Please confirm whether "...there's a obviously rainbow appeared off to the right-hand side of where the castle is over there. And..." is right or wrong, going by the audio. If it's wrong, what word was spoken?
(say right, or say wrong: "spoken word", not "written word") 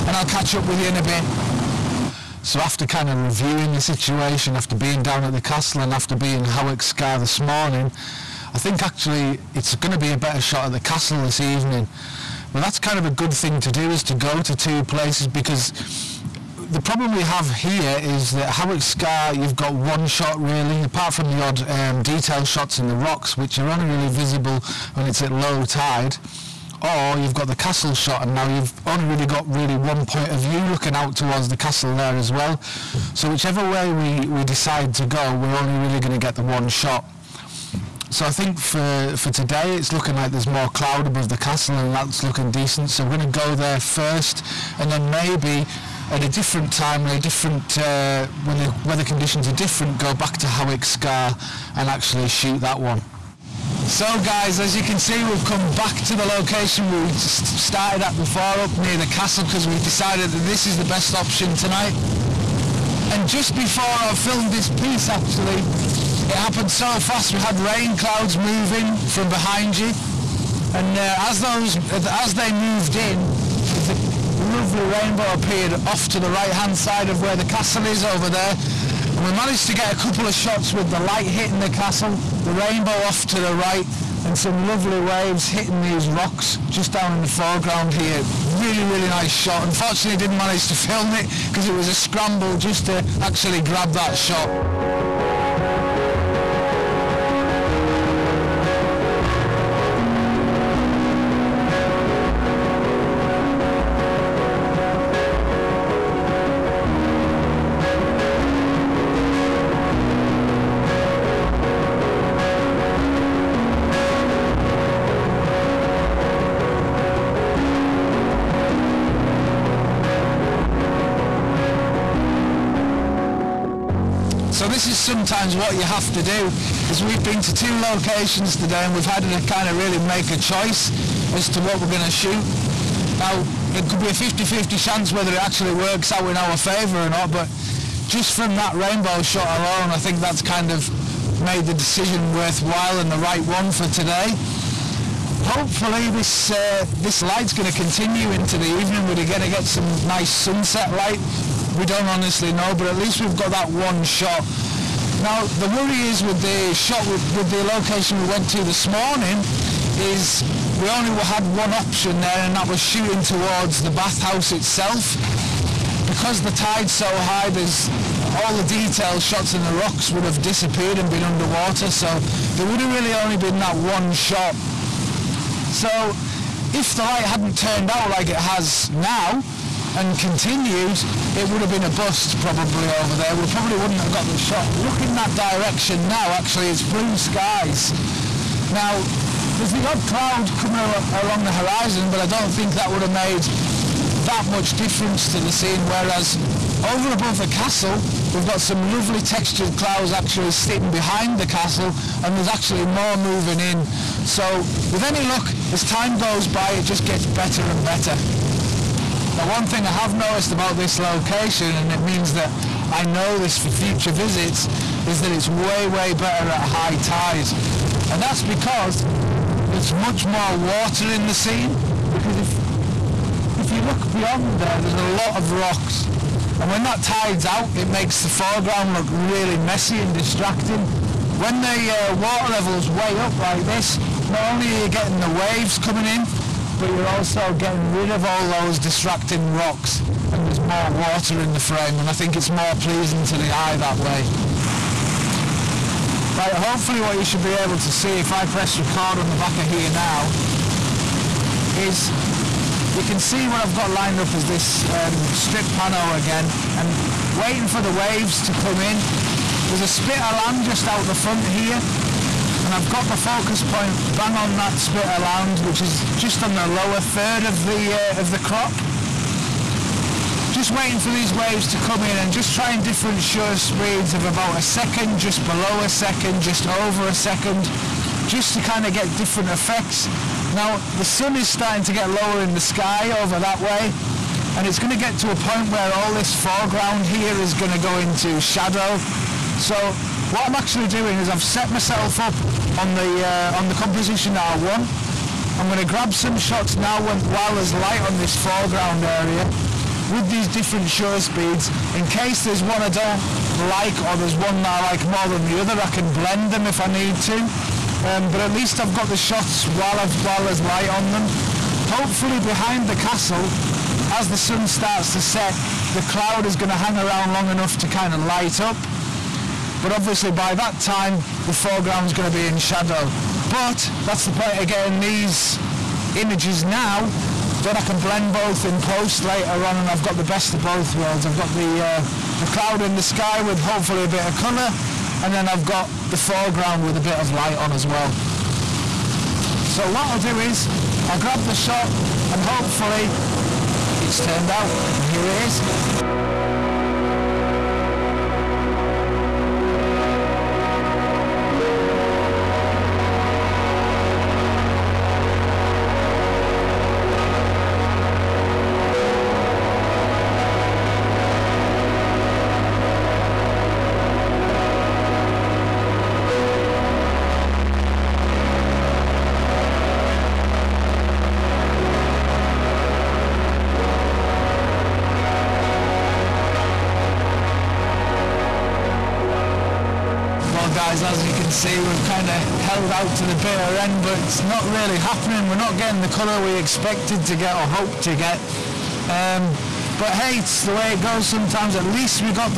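wrong: "lovely", not "obviously".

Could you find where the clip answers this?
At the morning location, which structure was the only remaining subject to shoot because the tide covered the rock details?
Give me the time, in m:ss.
2:43.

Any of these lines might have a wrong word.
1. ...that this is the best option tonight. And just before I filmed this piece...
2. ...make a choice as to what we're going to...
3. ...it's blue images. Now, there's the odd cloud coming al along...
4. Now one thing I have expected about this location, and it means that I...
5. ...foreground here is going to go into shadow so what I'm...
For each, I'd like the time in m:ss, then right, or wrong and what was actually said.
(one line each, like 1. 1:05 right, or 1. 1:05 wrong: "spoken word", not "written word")
1. 1:00 right
2. 2:10 right
3. 3:06 wrong: "skies", not "images"
4. 3:29 wrong: "noticed", not "expected"
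5. 4:46 right.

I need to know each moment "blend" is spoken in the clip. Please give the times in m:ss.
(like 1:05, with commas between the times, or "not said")
5:06, 5:27.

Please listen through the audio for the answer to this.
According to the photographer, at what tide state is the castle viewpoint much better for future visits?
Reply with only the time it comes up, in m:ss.
3:36.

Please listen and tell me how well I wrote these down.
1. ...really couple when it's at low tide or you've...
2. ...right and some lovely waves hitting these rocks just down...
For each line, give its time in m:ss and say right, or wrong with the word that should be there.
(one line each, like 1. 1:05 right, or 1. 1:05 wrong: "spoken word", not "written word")
1. 0:23 wrong: "visible", not "couple"
2. 1:23 right.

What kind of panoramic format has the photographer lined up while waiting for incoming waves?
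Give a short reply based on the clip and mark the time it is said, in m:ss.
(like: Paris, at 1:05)
Strip pano, at 4:15.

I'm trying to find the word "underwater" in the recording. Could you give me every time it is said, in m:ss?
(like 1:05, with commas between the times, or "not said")
2:51.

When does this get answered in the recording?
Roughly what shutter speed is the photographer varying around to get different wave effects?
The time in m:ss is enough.
4:34.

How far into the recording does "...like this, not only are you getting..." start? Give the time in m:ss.
3:53.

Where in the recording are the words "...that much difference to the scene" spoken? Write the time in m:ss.
3:14.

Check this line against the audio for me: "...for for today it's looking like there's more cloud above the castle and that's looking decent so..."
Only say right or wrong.
right.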